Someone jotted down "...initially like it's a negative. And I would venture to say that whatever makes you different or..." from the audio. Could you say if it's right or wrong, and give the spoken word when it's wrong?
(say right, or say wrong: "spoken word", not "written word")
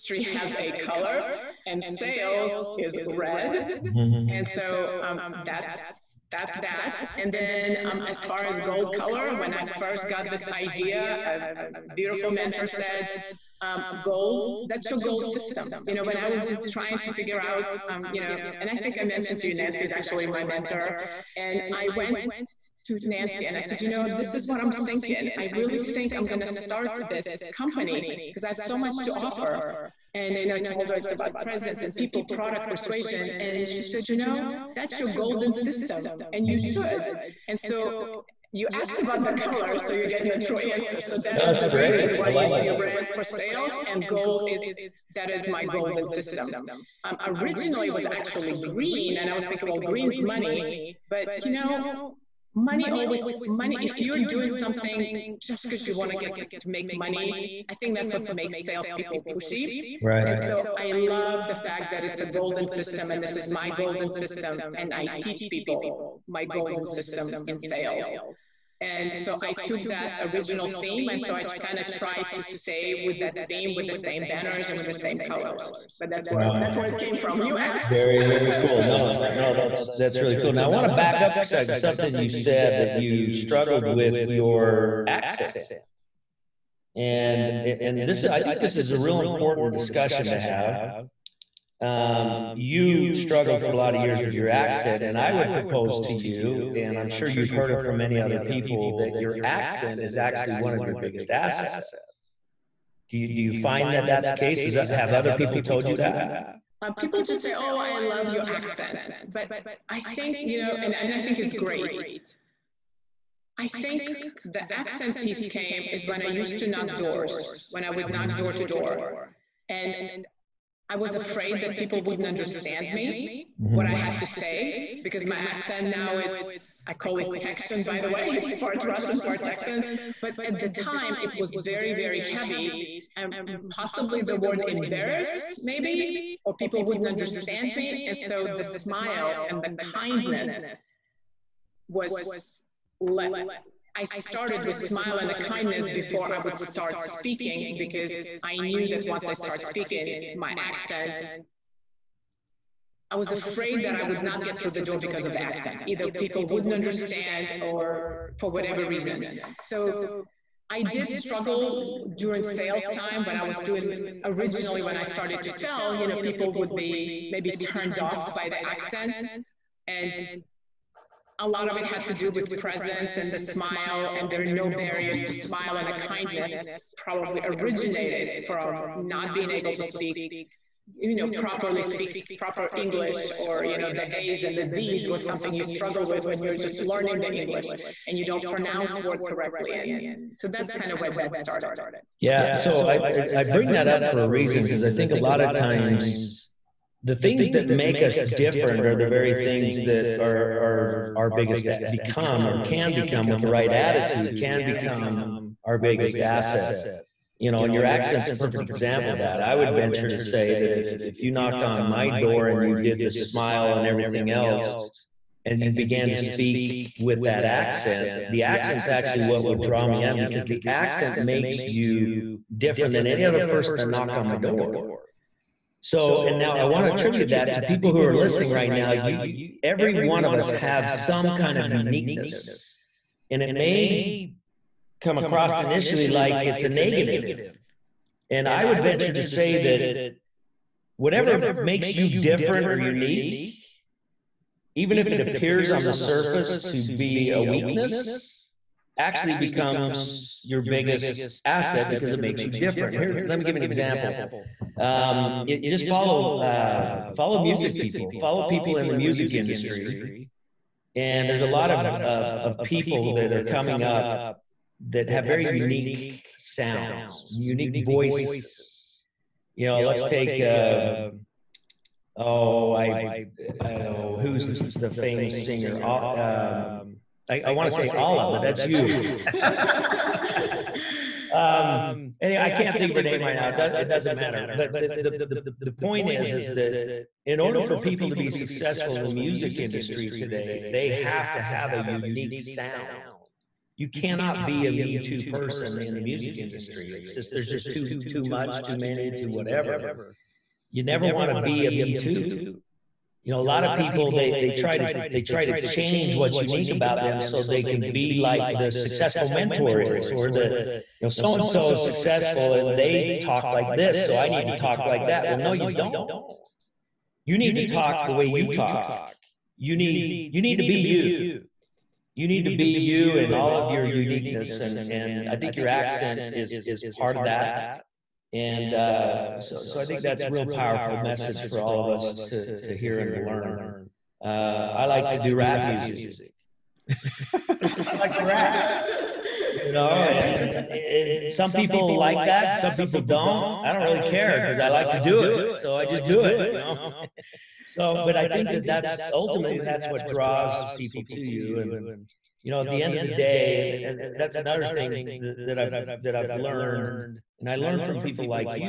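right.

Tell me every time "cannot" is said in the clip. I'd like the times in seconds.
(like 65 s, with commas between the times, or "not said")
293 s.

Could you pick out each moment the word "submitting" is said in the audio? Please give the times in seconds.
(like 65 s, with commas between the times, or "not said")
not said.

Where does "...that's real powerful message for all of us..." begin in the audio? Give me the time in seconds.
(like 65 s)
330 s.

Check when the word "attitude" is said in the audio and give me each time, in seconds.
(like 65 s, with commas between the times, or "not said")
203 s.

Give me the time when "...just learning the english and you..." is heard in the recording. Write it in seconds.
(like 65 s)
186 s.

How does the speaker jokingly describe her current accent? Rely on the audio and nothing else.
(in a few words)
Part Russian, part Texan.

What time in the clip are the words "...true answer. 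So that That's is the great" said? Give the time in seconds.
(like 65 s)
40 s.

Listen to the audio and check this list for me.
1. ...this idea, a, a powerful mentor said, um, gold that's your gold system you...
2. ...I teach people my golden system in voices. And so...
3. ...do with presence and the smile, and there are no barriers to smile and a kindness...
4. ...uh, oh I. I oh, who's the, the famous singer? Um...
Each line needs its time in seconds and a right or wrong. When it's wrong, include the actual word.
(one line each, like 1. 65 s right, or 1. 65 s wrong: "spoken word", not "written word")
1. 10 s wrong: "beautiful", not "powerful"
2. 64 s wrong: "sales", not "voices"
3. 172 s right
4. 270 s right.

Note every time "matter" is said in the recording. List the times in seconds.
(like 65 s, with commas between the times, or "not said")
284 s.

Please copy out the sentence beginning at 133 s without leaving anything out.
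And um, possibly the word embarrassed, maybe, or people wouldn't understand me.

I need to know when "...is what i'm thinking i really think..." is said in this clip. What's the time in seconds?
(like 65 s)
24 s.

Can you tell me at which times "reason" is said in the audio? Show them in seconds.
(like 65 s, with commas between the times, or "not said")
42 s, 158 s, 194 s.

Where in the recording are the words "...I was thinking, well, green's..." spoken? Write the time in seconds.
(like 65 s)
49 s.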